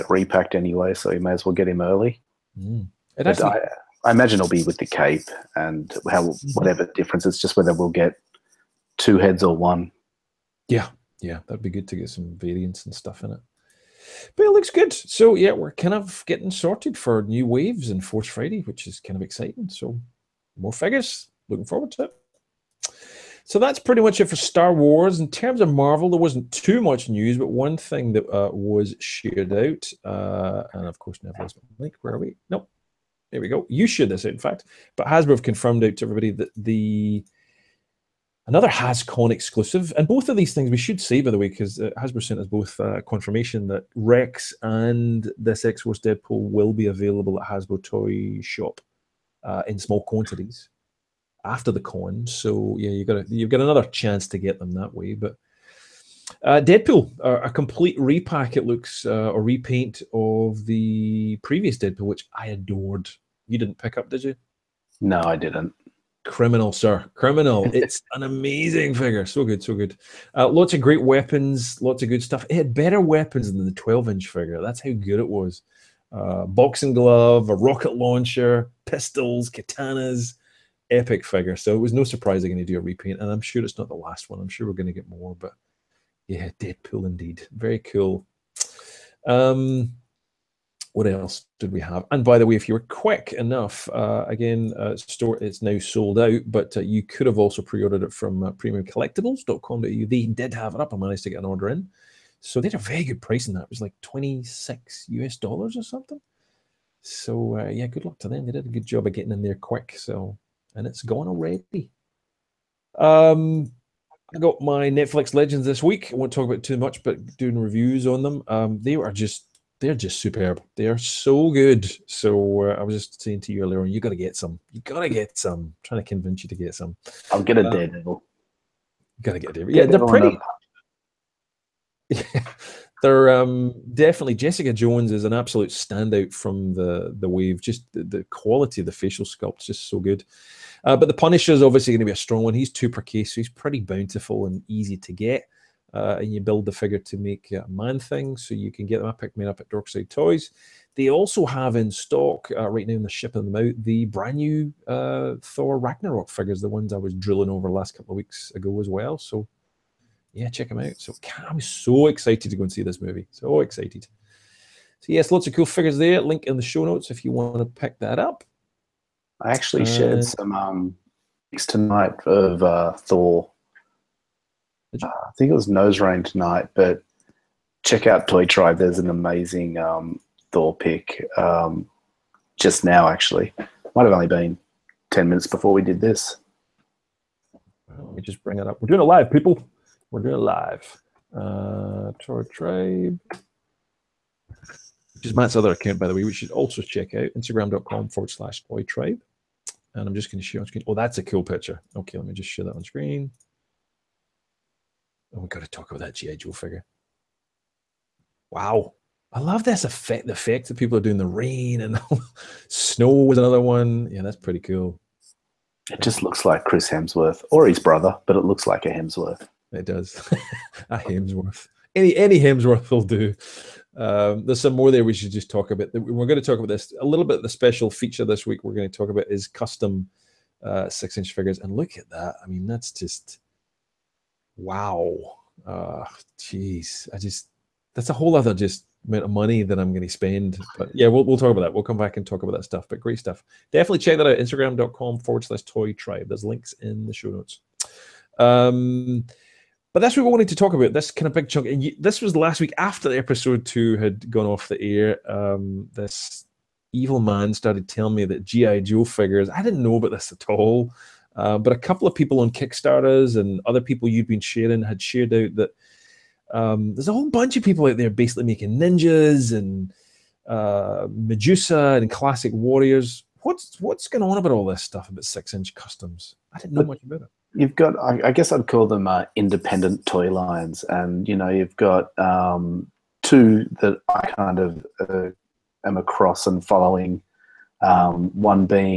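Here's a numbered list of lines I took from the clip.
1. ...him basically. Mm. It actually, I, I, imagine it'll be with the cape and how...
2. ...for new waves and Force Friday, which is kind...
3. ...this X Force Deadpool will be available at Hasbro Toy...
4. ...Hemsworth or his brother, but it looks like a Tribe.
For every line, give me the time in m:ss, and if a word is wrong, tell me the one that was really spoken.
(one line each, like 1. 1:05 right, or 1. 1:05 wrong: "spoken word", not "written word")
1. 0:01 wrong: "early", not "basically"
2. 0:16 right
3. 0:45 right
4. 3:36 wrong: "Hemsworth", not "Tribe".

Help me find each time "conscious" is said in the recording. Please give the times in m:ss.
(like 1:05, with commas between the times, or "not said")
not said.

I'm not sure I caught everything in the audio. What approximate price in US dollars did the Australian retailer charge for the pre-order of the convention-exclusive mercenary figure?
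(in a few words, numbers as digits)
26.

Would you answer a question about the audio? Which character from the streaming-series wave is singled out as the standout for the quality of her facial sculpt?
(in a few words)
Jessica Jones.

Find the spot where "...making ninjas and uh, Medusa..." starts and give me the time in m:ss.
4:28.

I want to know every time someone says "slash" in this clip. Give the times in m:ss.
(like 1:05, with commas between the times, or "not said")
3:18, 4:05.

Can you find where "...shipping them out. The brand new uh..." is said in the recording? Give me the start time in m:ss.
2:33.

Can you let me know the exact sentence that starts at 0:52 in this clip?
So yeah, you got you've got another chance to get them that way.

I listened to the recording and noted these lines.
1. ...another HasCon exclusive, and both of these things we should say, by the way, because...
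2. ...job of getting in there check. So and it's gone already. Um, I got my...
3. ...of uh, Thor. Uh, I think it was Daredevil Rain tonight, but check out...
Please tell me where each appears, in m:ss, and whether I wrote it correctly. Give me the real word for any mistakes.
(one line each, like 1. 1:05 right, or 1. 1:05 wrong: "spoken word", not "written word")
1. 0:38 right
2. 1:48 wrong: "quick", not "check"
3. 2:52 wrong: "Nose", not "Daredevil".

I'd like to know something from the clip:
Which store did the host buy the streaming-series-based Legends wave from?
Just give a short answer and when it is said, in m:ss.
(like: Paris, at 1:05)
Dorkside Toys, at 2:29.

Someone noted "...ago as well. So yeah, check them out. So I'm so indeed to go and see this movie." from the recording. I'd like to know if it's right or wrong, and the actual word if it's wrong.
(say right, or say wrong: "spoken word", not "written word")
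wrong: "excited", not "indeed".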